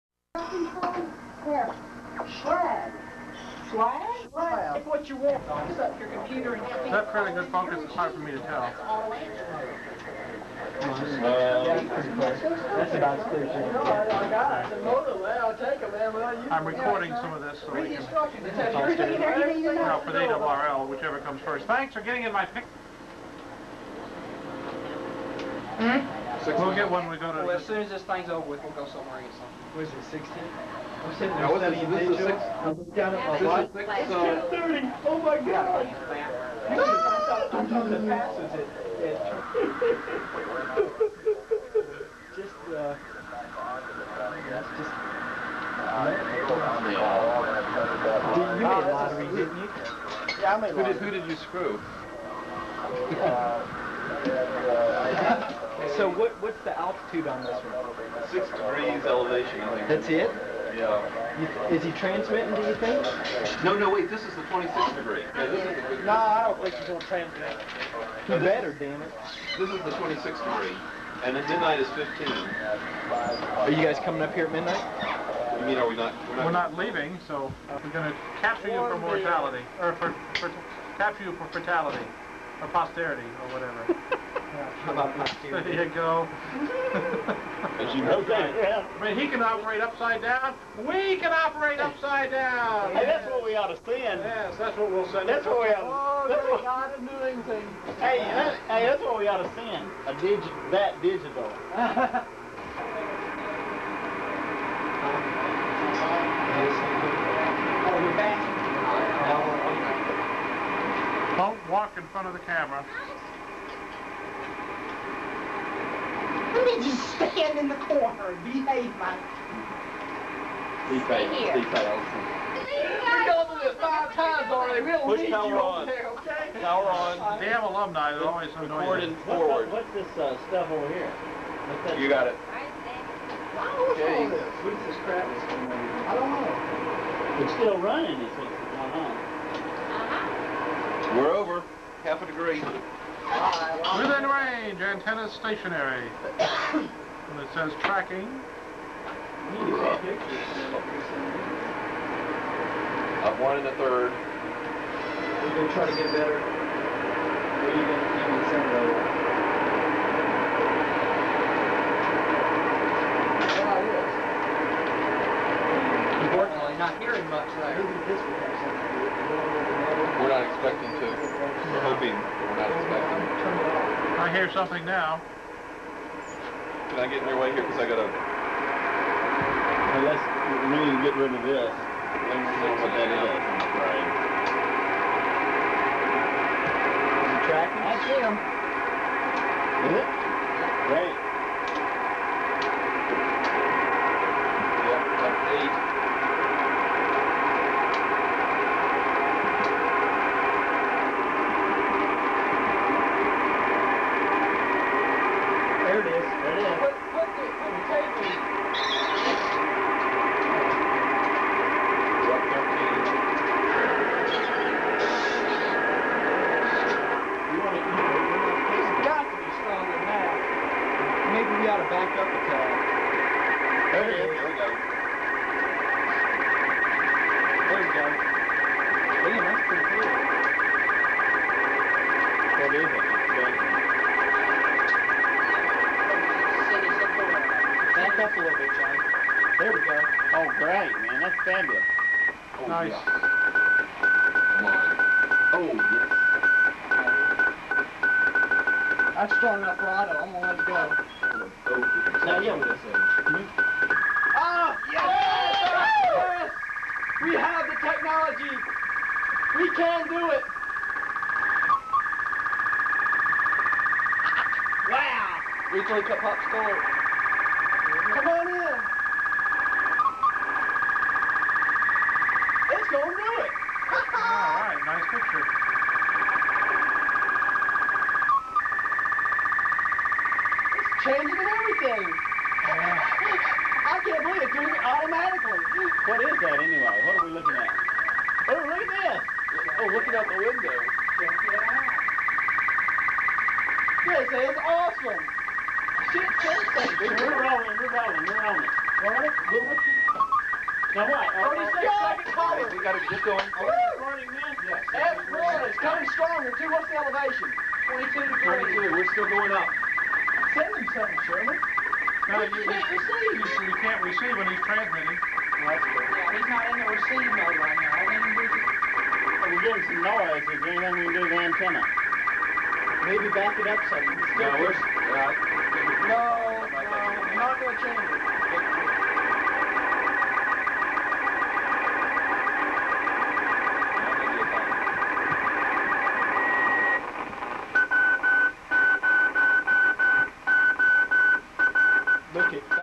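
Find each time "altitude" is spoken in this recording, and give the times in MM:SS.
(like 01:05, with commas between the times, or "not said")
00:56.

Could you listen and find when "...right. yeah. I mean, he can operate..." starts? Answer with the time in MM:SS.
01:28.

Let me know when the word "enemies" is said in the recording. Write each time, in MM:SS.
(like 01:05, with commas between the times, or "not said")
not said.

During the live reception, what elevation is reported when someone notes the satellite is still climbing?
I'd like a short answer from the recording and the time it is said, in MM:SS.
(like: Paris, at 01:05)
22 degrees, at 05:07.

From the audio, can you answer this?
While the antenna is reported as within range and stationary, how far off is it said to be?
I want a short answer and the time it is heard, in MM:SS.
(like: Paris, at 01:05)
Half a degree, at 02:22.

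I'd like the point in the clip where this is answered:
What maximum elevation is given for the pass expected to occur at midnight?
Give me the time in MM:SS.
01:11.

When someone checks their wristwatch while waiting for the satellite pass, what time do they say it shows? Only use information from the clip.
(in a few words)
10:30.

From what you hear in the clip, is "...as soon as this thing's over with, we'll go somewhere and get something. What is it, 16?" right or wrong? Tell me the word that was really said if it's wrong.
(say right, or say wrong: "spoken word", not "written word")
right.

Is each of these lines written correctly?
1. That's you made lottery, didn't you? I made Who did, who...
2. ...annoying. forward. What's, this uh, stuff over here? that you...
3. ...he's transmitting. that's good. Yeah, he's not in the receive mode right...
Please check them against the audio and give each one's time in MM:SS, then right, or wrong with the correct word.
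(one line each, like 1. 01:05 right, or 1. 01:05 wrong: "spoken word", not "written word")
1. 00:44 right
2. 02:08 right
3. 05:14 right.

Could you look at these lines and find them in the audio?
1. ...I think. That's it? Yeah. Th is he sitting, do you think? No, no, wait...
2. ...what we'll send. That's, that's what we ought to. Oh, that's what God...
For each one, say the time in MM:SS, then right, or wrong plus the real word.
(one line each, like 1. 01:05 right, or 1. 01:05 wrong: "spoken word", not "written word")
1. 00:59 wrong: "transmitting", not "sitting"
2. 01:34 right.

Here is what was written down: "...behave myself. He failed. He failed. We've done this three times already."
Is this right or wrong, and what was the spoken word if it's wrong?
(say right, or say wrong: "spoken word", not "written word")
wrong: "five", not "three".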